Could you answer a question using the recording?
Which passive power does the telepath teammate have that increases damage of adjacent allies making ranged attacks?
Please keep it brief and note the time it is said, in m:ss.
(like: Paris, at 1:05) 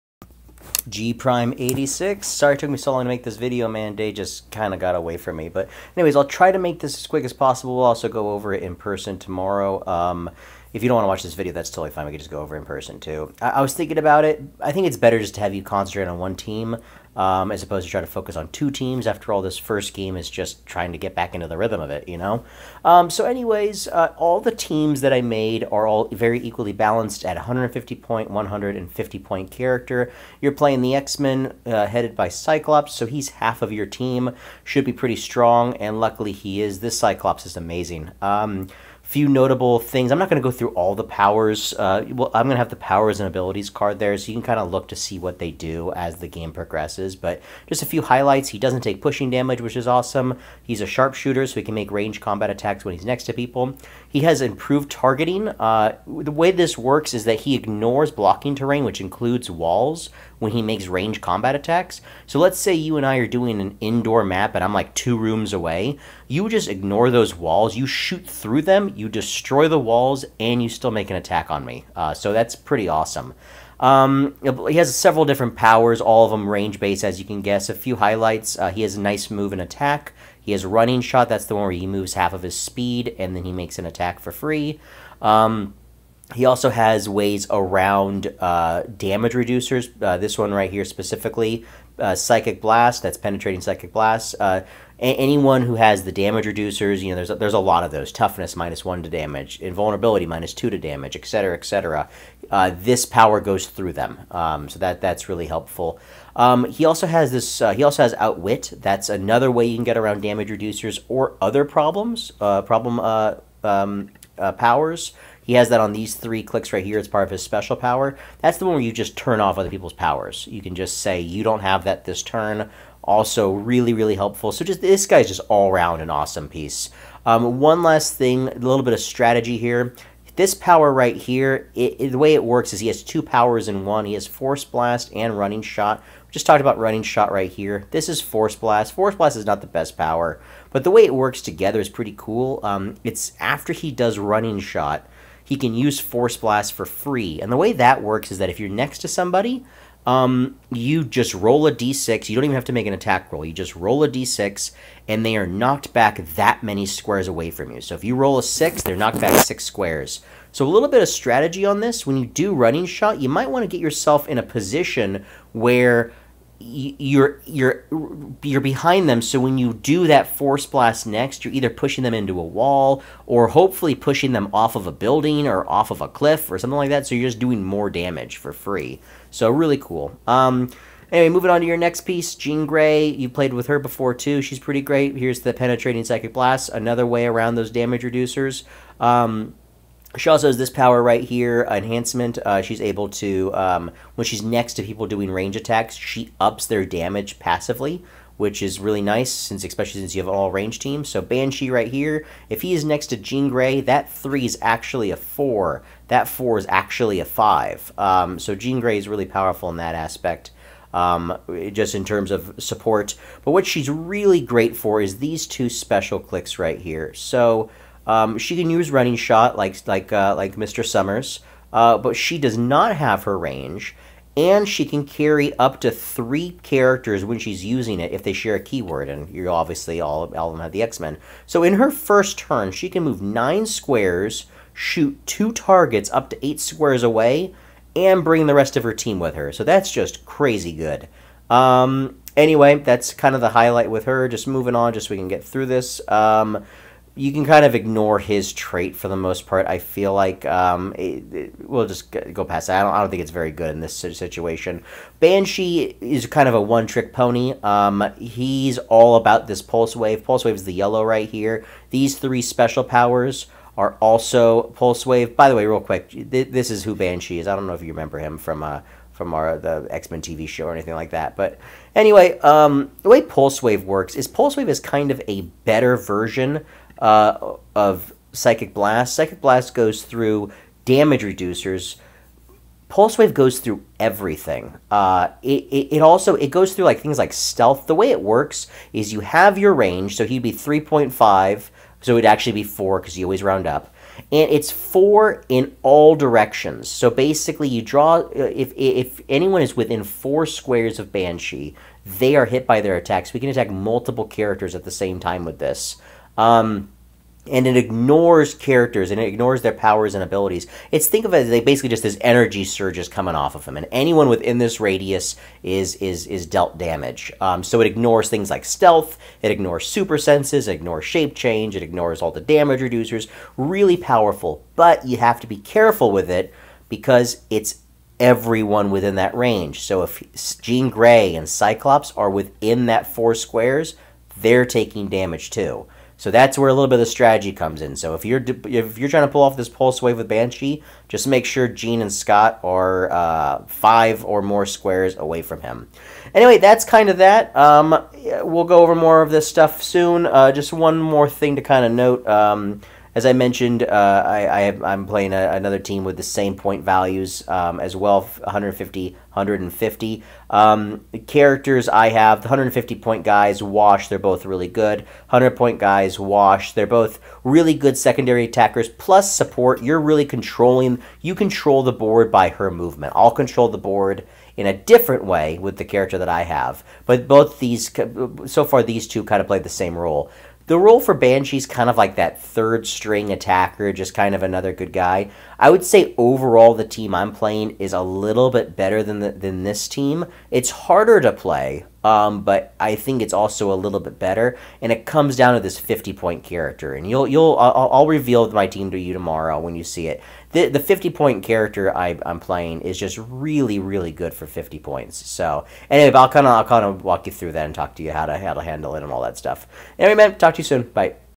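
Enhancement, at 3:11.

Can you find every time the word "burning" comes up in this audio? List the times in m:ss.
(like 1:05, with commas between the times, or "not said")
not said.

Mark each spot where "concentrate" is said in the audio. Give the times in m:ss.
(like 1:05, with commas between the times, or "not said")
0:15.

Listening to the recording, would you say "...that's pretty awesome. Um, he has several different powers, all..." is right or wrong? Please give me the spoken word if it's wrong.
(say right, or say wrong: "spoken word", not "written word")
right.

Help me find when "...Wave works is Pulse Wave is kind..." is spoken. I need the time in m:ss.
4:33.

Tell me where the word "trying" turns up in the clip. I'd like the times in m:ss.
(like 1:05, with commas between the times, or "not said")
0:20, 5:39.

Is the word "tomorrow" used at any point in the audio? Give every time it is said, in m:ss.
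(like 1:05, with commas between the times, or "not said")
0:09, 6:39.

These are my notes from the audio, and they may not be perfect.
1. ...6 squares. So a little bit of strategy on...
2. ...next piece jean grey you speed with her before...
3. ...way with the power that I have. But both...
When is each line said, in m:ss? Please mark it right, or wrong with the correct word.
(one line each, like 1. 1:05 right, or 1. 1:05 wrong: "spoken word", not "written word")
1. 2:39 right
2. 3:01 wrong: "played", not "speed"
3. 6:15 wrong: "character", not "power".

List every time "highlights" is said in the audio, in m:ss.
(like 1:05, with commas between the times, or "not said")
0:48, 1:17, 4:03.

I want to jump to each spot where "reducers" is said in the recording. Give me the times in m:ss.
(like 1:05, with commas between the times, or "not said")
1:29, 1:36, 1:50, 3:08, 4:41, 5:22.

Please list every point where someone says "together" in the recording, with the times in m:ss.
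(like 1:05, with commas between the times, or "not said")
2:21.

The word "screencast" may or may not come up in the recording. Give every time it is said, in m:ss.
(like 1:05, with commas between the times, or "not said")
not said.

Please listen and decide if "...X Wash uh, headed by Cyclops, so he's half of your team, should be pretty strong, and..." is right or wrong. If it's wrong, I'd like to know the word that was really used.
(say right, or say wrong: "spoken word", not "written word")
wrong: "Men", not "Wash".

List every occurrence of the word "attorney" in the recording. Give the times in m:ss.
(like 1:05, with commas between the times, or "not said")
not said.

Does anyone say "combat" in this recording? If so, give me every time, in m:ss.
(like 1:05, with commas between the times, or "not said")
0:52, 1:01.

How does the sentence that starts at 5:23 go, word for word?
Really powerful, but you have to be careful with it because it's everyone within that range.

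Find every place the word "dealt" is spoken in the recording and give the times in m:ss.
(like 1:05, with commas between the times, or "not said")
5:16.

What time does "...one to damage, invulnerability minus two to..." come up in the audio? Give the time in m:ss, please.
1:38.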